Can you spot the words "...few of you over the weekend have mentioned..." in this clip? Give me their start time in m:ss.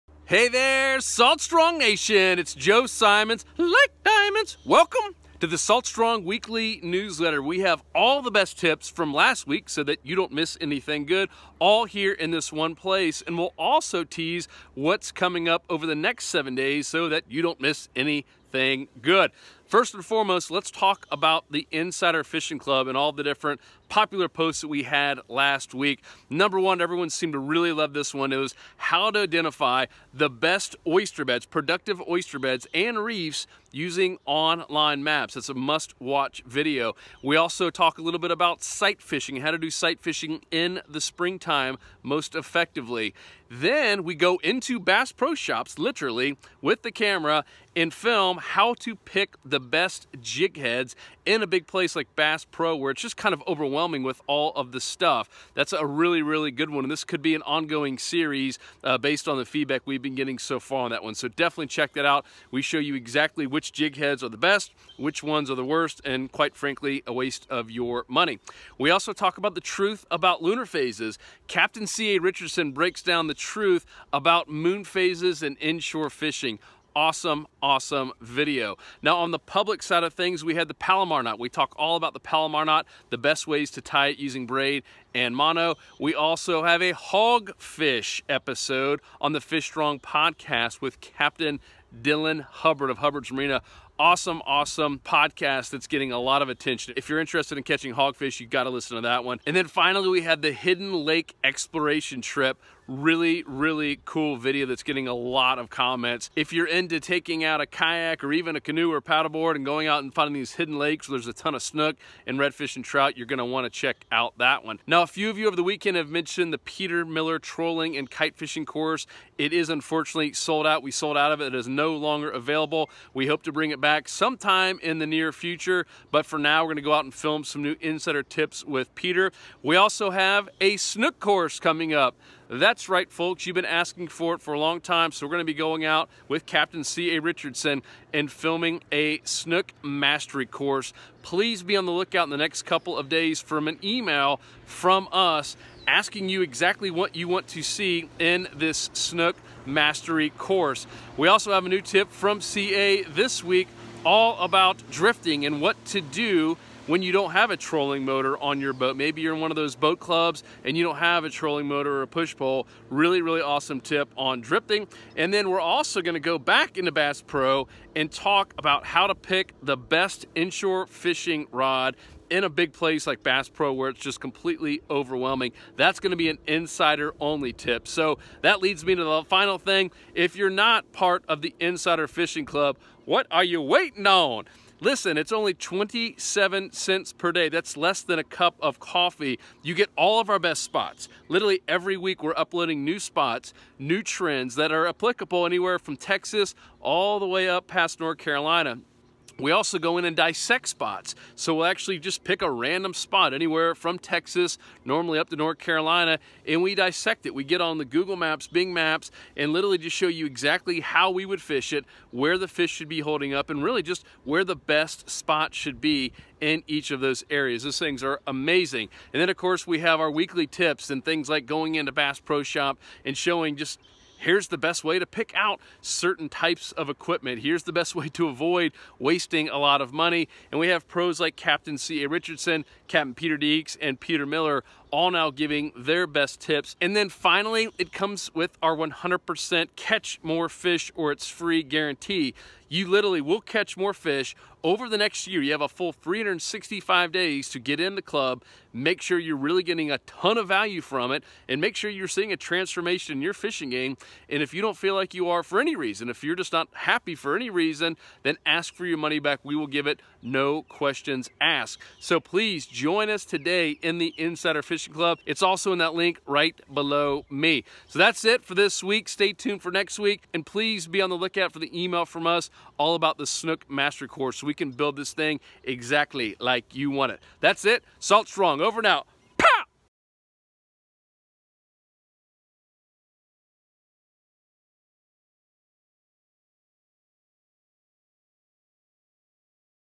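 1:55.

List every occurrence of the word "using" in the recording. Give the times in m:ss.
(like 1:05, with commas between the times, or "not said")
0:33, 1:24.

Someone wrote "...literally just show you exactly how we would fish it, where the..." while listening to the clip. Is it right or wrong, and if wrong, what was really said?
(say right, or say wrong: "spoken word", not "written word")
right.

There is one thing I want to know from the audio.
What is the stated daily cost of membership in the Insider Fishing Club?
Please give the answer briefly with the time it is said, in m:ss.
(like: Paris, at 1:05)
27 cents, at 3:05.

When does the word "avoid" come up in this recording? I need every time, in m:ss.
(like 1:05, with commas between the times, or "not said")
3:48.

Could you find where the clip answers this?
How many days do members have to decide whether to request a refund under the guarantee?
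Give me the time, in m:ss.
4:05.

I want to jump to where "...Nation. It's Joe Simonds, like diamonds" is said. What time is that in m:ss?
0:01.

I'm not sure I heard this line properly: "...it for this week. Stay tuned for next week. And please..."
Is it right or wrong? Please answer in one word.
right.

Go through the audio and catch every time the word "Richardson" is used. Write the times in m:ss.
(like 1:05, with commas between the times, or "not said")
1:12, 2:17, 3:52.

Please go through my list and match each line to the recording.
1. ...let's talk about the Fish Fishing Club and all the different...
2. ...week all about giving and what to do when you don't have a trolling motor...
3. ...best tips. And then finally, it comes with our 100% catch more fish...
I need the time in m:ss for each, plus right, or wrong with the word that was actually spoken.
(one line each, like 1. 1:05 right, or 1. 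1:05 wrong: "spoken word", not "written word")
1. 0:20 wrong: "Insider", not "Fish"
2. 2:33 wrong: "drifting", not "giving"
3. 3:56 right.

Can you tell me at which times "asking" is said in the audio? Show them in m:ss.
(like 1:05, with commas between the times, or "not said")
2:13, 2:25.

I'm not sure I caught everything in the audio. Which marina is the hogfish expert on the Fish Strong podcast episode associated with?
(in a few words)
Hubbard's Marina.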